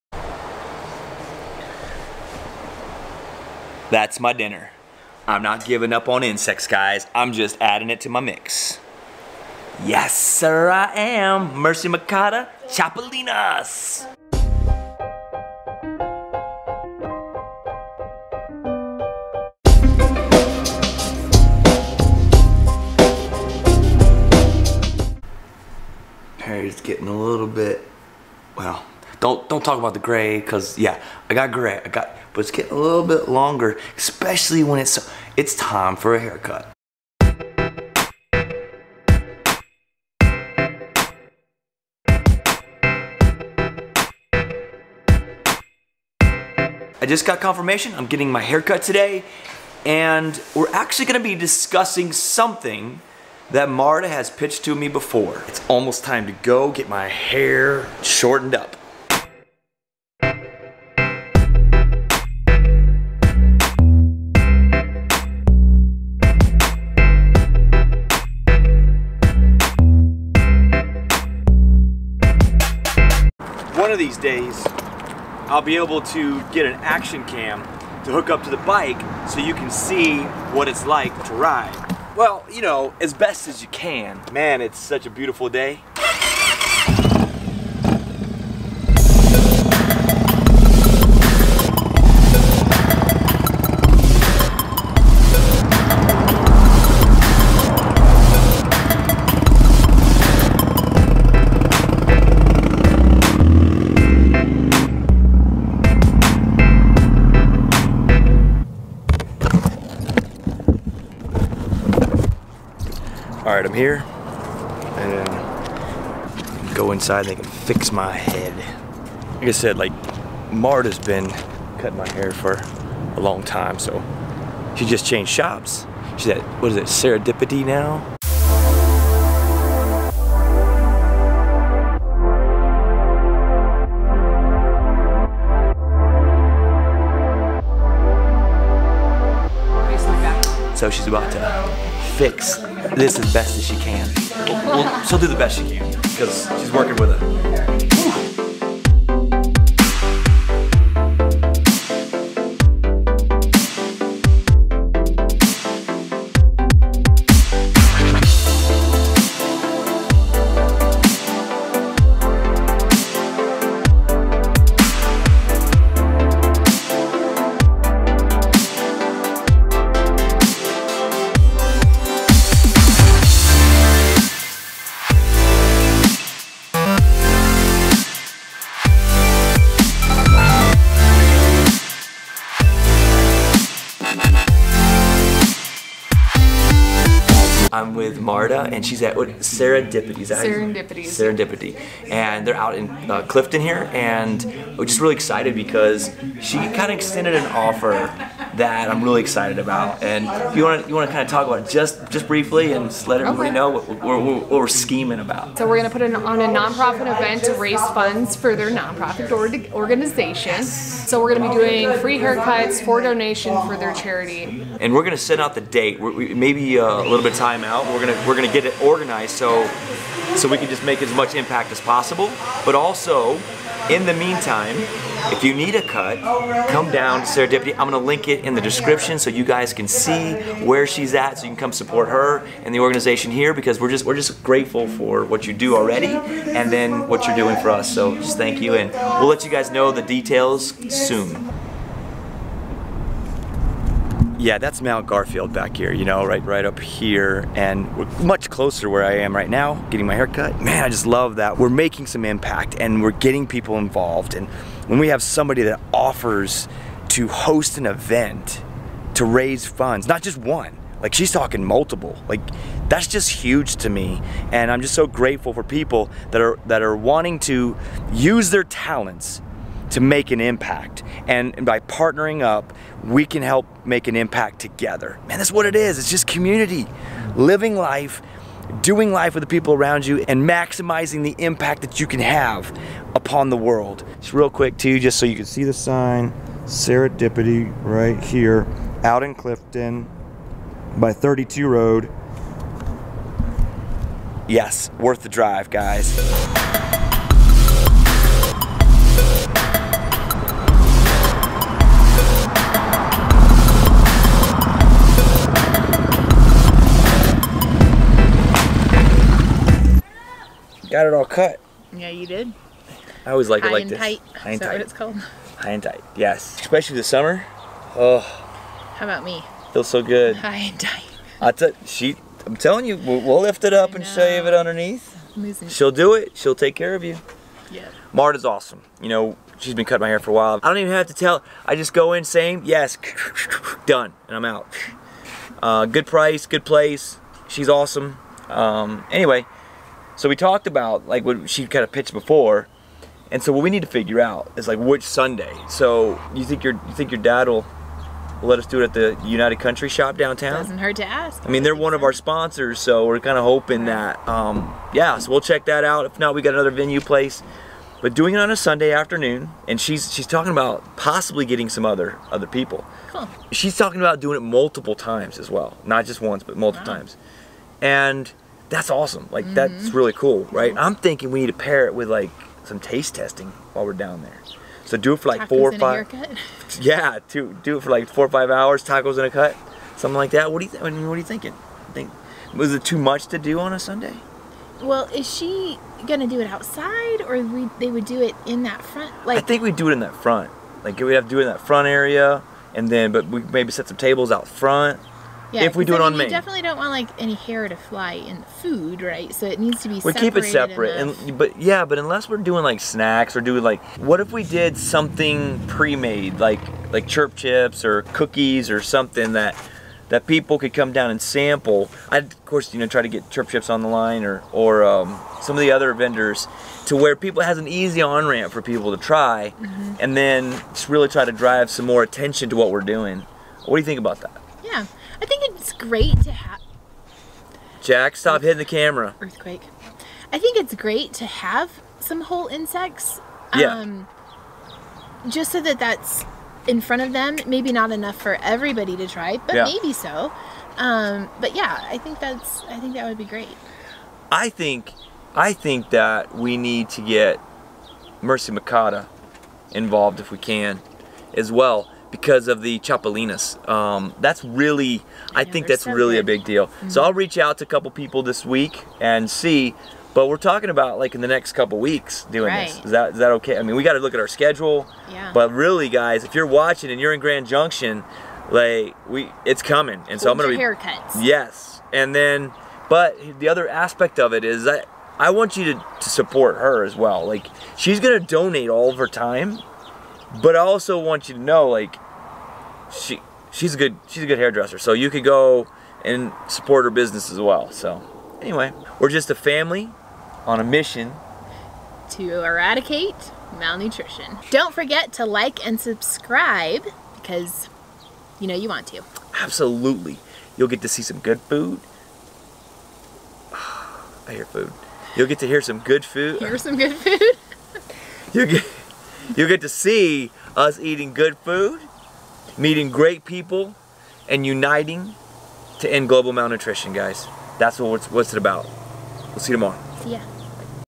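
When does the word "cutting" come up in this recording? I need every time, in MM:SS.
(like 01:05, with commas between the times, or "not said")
02:01, 05:29.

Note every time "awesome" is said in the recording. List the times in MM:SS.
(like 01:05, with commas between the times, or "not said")
05:28, 05:37, 06:08.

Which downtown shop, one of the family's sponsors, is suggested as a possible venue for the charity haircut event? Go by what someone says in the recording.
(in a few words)
United Country Shop.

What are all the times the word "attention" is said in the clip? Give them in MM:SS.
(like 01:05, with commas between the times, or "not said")
07:02.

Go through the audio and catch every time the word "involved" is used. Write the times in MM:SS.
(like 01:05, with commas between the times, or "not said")
04:13, 07:29.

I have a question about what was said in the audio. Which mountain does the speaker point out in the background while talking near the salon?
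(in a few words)
Mount Garfield.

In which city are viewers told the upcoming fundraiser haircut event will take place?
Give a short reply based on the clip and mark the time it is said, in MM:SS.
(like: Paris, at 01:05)
Grand Junction, at 07:47.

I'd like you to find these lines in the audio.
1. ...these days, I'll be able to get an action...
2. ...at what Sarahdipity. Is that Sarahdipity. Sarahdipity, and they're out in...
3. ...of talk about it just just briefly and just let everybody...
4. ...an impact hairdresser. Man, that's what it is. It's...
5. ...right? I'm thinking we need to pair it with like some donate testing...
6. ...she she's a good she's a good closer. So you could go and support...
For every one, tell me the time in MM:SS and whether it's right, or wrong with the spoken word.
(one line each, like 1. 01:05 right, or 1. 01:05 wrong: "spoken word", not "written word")
1. 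01:14 right
2. 03:09 right
3. 03:21 right
4. 04:34 wrong: "together", not "hairdresser"
5. 06:10 wrong: "taste", not "donate"
6. 08:02 wrong: "hairdresser", not "closer".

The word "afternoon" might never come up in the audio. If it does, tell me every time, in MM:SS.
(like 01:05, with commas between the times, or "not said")
05:58.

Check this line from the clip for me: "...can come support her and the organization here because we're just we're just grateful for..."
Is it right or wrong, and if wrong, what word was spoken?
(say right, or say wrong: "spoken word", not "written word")
right.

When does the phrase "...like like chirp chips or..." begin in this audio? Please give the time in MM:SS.
06:46.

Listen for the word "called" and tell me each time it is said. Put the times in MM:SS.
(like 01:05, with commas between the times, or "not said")
05:14.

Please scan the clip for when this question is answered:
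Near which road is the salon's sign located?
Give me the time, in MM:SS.
04:51.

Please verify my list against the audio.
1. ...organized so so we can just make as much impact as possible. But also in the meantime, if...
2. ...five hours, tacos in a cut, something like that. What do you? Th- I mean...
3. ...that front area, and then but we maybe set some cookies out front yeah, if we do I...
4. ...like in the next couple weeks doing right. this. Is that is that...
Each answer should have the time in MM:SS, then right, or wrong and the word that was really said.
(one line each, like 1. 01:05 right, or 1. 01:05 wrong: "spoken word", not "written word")
1. 03:38 right
2. 06:18 right
3. 06:31 wrong: "tables", not "cookies"
4. 07:41 right.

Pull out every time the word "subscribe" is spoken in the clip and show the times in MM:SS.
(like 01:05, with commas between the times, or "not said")
08:15.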